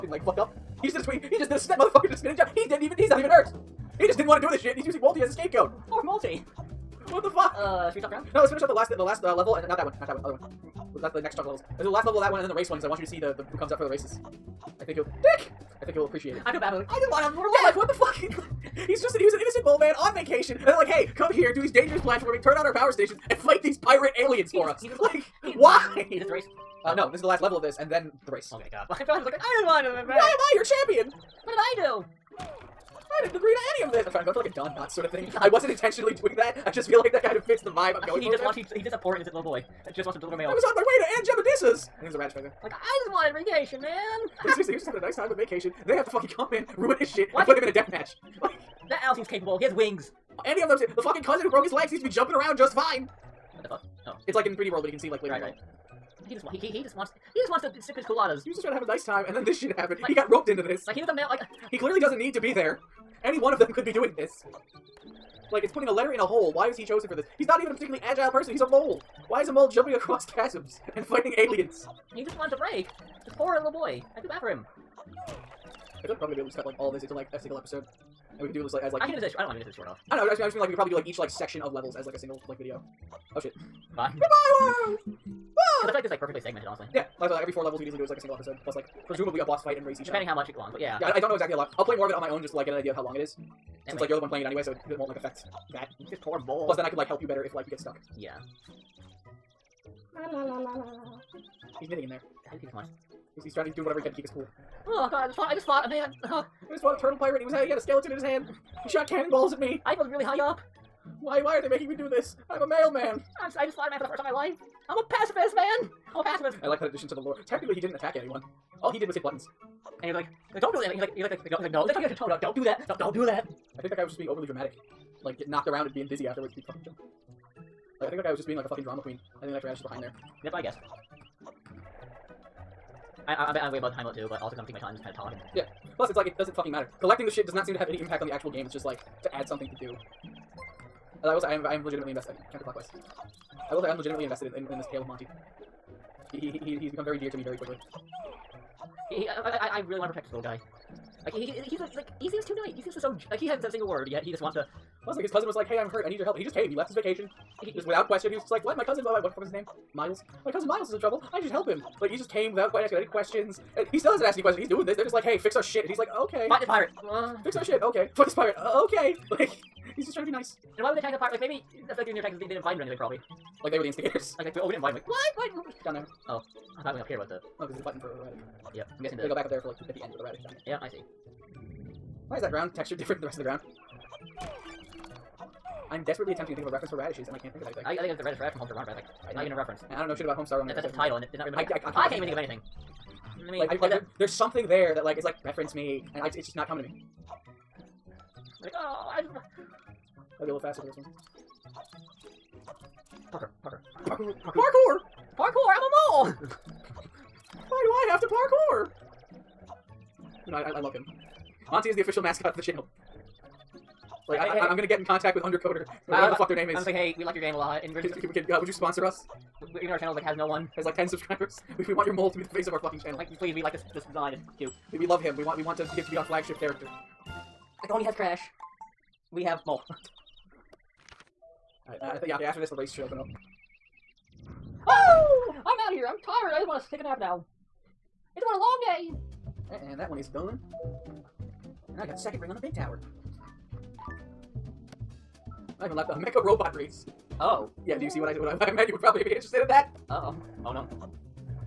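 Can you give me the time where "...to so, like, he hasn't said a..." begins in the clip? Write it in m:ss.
2:32.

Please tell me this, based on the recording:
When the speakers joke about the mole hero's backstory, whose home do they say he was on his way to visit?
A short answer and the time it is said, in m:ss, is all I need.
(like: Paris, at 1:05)
Aunt Jebedissa's, at 0:41.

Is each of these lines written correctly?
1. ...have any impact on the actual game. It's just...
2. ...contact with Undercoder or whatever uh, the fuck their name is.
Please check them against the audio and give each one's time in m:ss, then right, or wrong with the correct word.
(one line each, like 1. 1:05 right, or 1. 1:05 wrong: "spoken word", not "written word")
1. 2:17 right
2. 3:35 right.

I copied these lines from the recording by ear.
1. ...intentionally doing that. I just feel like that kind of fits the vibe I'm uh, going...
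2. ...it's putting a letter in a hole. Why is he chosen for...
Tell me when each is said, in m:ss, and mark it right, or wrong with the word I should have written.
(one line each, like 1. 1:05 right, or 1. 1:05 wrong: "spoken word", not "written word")
1. 0:35 right
2. 1:05 right.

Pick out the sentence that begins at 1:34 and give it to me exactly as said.
like you're the one playing it anyway, so it won't like affect that.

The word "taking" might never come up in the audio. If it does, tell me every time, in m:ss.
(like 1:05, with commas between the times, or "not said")
2:14.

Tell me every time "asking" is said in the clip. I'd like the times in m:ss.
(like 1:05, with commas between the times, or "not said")
2:42.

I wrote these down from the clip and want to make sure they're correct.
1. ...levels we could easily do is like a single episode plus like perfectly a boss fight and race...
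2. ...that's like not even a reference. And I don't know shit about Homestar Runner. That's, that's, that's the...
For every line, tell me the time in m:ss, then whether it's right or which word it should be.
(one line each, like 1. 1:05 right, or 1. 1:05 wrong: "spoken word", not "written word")
1. 1:27 wrong: "presumably", not "perfectly"
2. 3:08 right.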